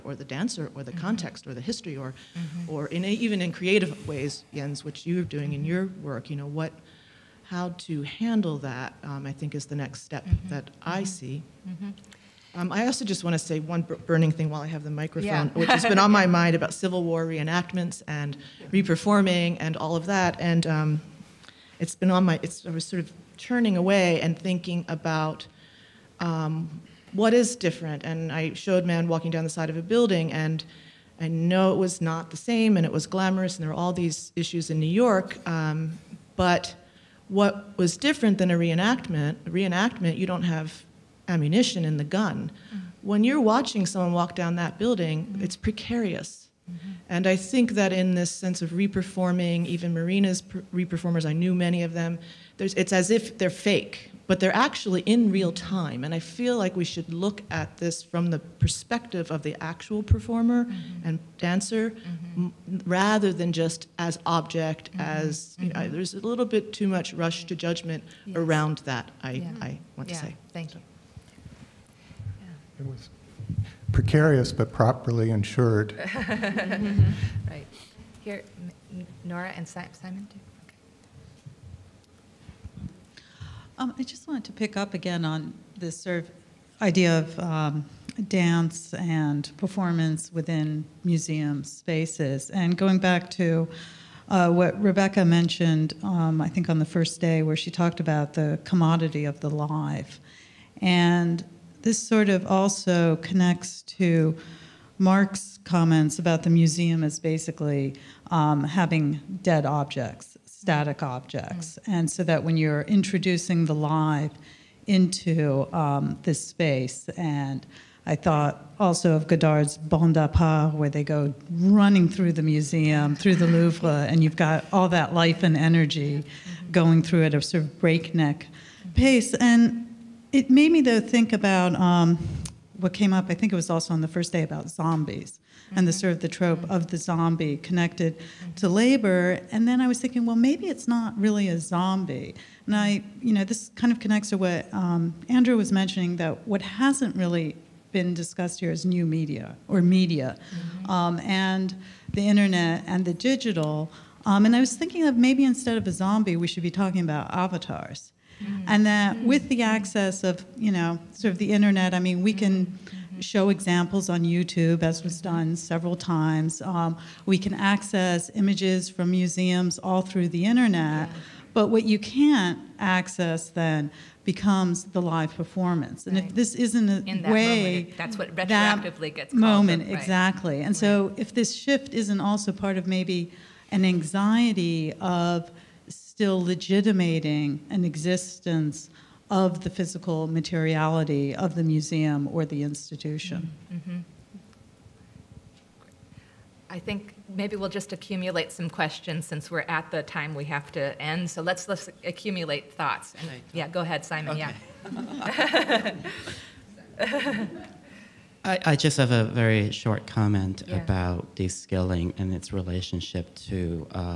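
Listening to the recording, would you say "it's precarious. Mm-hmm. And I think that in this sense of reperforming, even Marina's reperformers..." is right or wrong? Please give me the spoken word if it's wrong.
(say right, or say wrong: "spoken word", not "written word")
right.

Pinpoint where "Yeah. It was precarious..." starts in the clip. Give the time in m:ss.
1:12.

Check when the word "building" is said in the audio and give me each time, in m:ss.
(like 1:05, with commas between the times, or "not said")
0:29, 0:44.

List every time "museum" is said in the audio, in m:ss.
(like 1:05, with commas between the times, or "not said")
1:31, 1:46, 2:02, 2:49, 3:11.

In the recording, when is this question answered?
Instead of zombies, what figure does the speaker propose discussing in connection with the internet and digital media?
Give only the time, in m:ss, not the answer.
2:37.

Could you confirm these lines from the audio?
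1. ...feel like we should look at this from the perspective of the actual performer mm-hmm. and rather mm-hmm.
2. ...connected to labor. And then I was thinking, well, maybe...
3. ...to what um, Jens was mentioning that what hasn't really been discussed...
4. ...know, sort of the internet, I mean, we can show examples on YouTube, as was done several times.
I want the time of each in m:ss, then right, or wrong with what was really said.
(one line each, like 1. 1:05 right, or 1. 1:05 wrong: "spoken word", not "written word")
1. 0:56 wrong: "dancer", not "rather"
2. 2:17 right
3. 2:24 wrong: "Andrew", not "Jens"
4. 2:40 right.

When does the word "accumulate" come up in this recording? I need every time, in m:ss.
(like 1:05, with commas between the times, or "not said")
3:17, 3:22.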